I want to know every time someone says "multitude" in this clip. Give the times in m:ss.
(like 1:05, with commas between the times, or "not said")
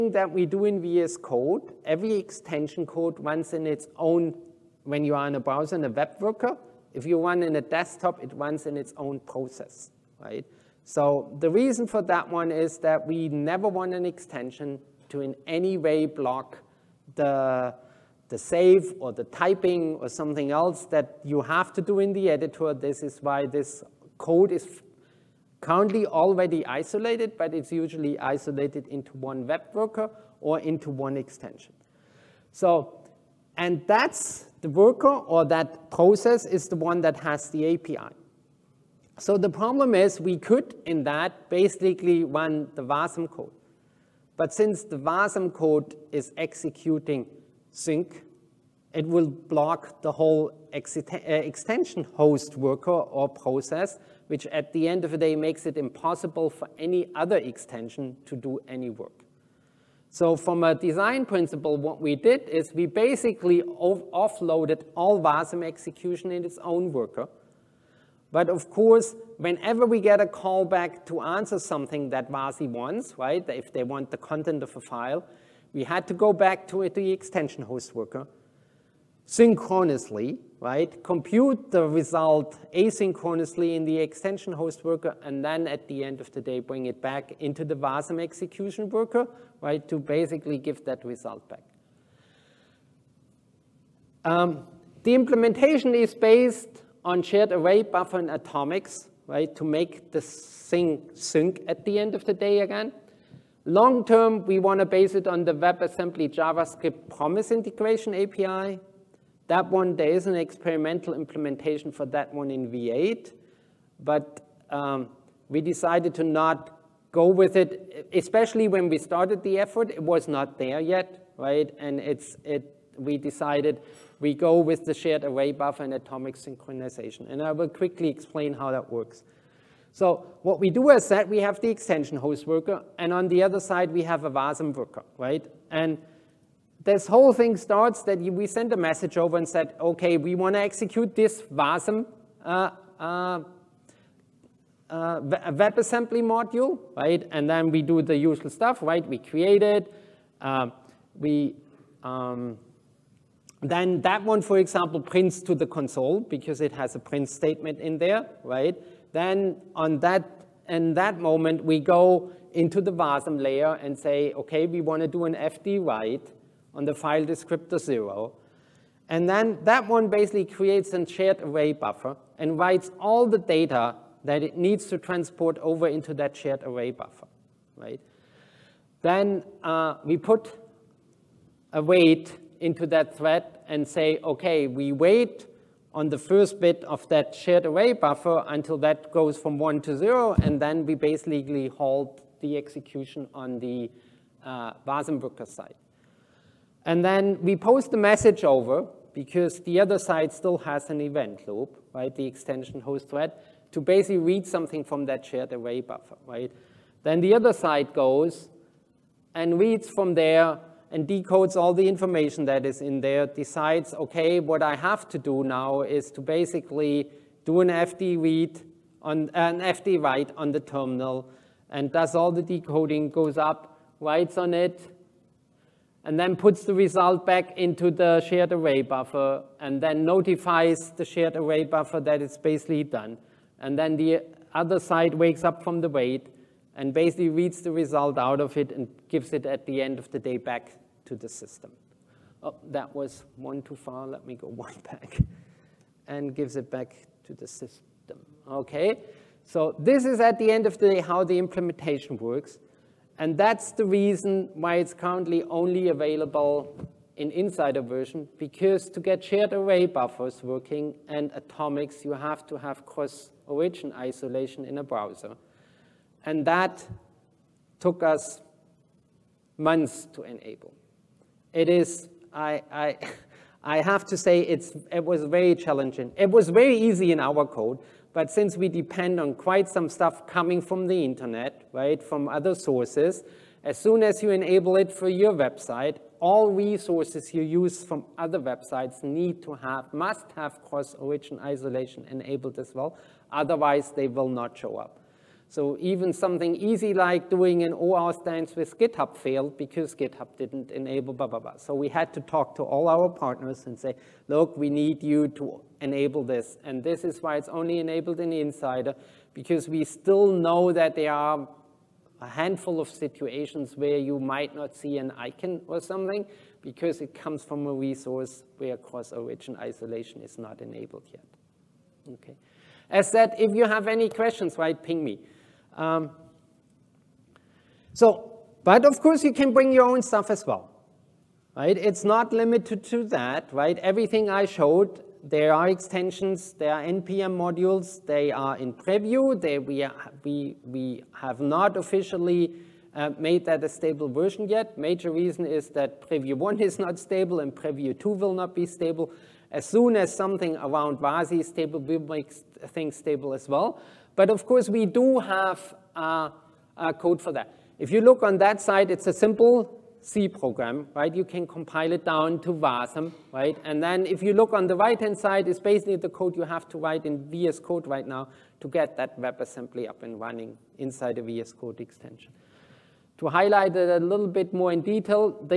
not said.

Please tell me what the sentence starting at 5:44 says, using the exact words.
Major reason is that preview 1 is not stable and preview 2 will not be stable.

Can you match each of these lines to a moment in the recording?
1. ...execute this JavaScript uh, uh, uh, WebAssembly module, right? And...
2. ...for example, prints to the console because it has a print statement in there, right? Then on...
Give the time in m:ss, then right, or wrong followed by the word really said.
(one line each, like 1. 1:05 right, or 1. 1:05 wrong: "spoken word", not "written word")
1. 2:20 wrong: "WASM", not "JavaScript"
2. 2:34 right.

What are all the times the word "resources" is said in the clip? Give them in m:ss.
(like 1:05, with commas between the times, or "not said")
4:46, 5:17.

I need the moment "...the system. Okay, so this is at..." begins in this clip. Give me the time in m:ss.
4:07.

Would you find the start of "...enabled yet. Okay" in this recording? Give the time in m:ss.
5:20.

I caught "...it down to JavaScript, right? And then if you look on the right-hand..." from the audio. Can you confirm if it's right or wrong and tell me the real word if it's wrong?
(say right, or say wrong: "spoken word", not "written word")
wrong: "Wasm", not "JavaScript".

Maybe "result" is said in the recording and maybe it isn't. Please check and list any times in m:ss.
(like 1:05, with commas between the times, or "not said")
1:21, 1:31, 3:46, 3:57.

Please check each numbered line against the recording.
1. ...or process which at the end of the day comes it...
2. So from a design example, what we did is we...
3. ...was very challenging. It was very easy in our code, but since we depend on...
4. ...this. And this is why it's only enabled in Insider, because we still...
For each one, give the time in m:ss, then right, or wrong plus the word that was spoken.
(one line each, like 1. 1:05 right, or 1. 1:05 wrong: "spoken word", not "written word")
1. 0:52 wrong: "makes", not "comes"
2. 1:00 wrong: "principle", not "example"
3. 4:35 right
4. 5:06 right.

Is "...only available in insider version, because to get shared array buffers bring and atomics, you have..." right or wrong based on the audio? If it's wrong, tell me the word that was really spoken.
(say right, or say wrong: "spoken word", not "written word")
wrong: "working", not "bring".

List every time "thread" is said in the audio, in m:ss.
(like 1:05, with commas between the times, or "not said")
3:03, 3:23.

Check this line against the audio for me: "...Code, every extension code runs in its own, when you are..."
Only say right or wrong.
right.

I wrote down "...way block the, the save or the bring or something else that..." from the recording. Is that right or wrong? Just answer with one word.
wrong.